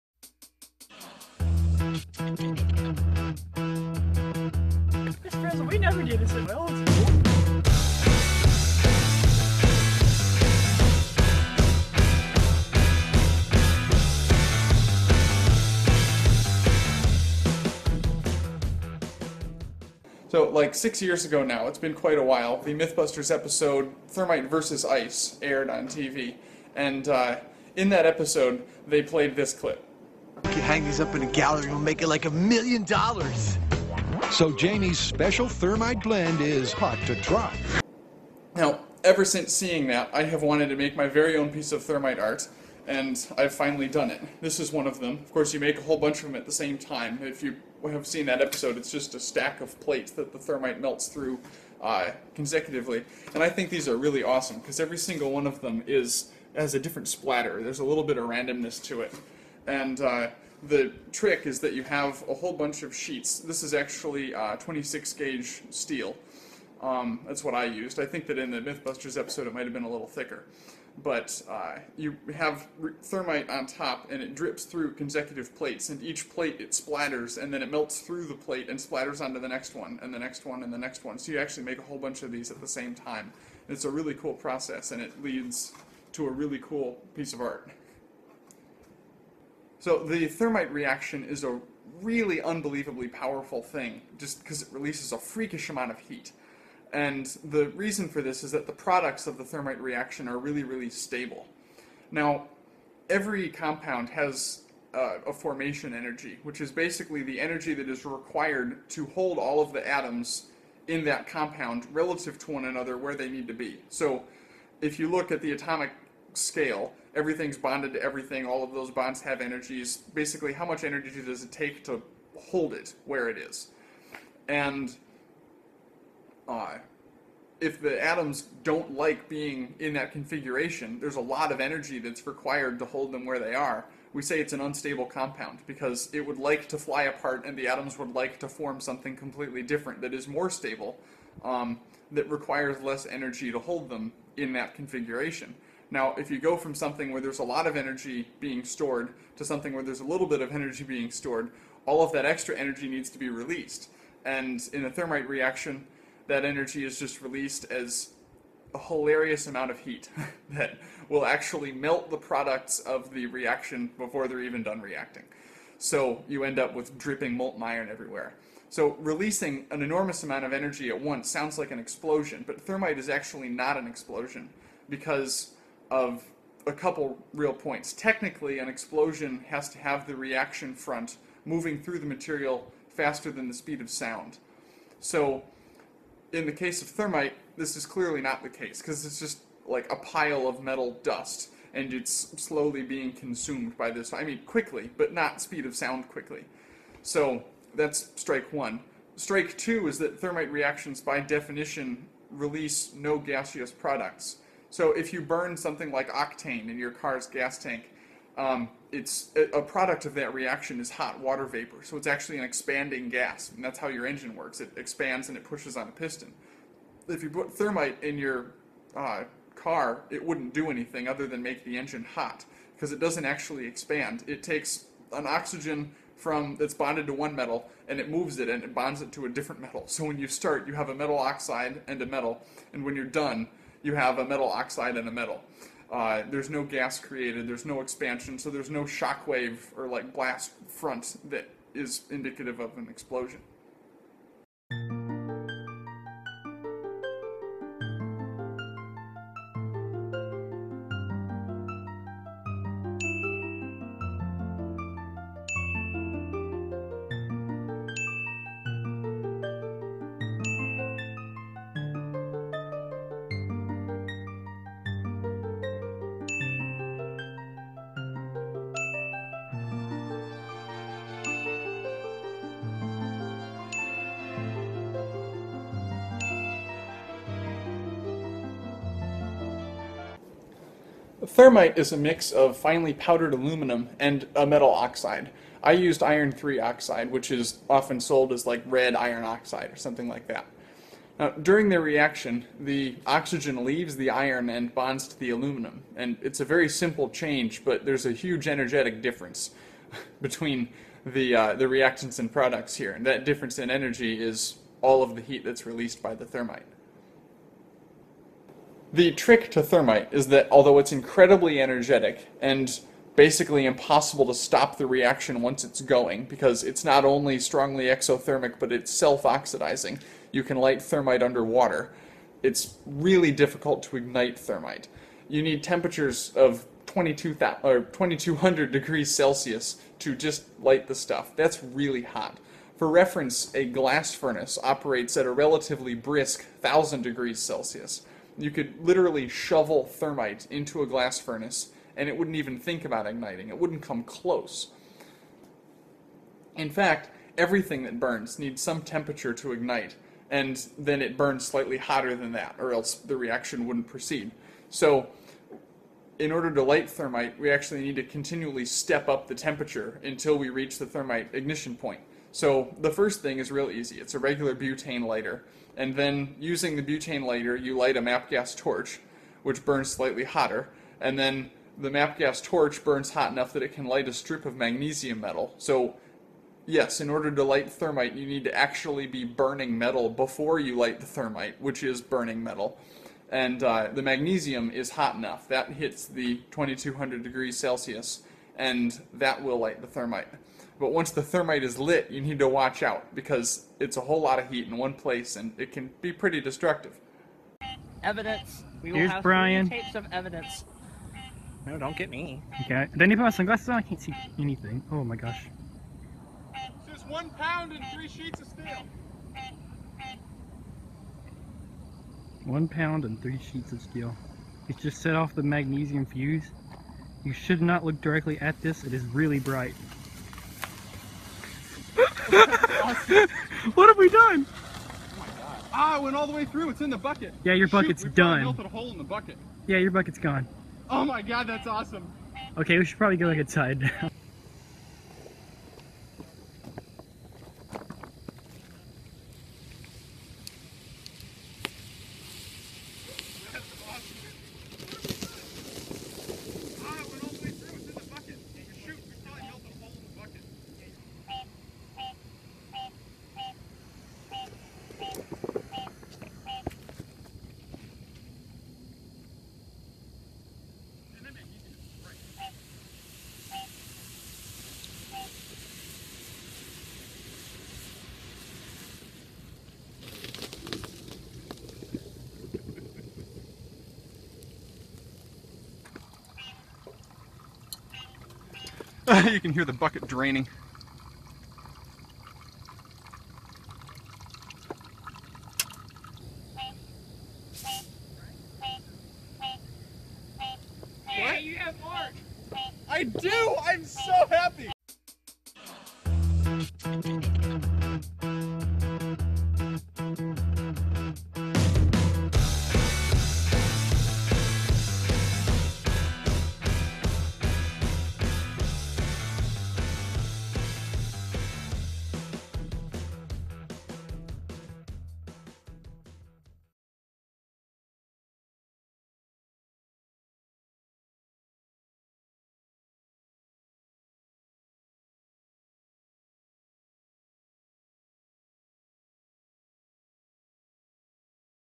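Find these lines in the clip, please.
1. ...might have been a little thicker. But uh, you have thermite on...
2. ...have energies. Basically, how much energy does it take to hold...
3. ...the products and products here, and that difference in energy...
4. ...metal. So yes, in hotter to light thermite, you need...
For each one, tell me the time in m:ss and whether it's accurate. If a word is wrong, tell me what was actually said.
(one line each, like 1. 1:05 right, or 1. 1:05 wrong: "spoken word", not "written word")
1. 1:09 right
2. 1:59 right
3. 5:01 wrong: "reactants", not "products"
4. 6:15 wrong: "order", not "hotter".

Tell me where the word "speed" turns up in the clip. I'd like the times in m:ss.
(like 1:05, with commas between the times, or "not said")
3:03, 3:15.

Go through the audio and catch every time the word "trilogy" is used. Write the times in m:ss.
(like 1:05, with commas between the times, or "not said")
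not said.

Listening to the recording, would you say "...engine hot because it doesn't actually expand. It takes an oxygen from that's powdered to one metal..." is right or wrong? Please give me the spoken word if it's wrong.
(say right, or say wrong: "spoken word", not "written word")
wrong: "bonded", not "powdered".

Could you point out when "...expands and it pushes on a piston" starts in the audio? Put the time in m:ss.
3:34.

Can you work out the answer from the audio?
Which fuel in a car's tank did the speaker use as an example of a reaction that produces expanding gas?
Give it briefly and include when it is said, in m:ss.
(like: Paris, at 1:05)
Octane, at 3:26.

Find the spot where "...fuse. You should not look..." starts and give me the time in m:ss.
6:56.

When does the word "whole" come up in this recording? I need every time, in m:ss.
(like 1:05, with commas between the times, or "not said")
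0:45, 1:02, 1:21, 6:34.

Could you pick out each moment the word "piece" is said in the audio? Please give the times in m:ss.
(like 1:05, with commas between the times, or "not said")
0:41, 1:27.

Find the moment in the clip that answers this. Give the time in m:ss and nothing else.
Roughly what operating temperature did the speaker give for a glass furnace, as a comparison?
5:36.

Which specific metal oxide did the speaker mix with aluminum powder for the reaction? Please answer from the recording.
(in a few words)
Iron 3 oxide.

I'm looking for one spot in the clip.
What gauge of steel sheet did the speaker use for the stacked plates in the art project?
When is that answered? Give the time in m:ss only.
1:04.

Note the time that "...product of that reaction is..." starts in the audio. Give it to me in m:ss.
3:29.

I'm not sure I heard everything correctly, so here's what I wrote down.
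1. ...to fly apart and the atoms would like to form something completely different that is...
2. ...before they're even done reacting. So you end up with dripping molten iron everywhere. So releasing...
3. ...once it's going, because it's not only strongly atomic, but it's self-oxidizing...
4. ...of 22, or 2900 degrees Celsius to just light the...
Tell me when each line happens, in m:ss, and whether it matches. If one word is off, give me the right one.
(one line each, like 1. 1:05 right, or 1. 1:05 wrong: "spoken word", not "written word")
1. 2:16 right
2. 2:43 right
3. 5:15 wrong: "exothermic", not "atomic"
4. 5:26 wrong: "2200", not "2900".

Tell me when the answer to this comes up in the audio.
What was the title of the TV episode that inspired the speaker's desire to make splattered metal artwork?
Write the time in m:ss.
0:24.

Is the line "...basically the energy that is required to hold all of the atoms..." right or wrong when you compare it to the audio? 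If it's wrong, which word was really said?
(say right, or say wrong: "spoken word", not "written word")
right.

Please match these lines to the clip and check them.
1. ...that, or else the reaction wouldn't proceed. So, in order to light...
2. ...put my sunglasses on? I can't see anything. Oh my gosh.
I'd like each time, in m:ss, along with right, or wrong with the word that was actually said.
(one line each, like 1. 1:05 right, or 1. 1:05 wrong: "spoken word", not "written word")
1. 5:52 right
2. 6:43 right.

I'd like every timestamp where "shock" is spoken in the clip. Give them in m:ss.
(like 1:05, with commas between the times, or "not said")
3:58.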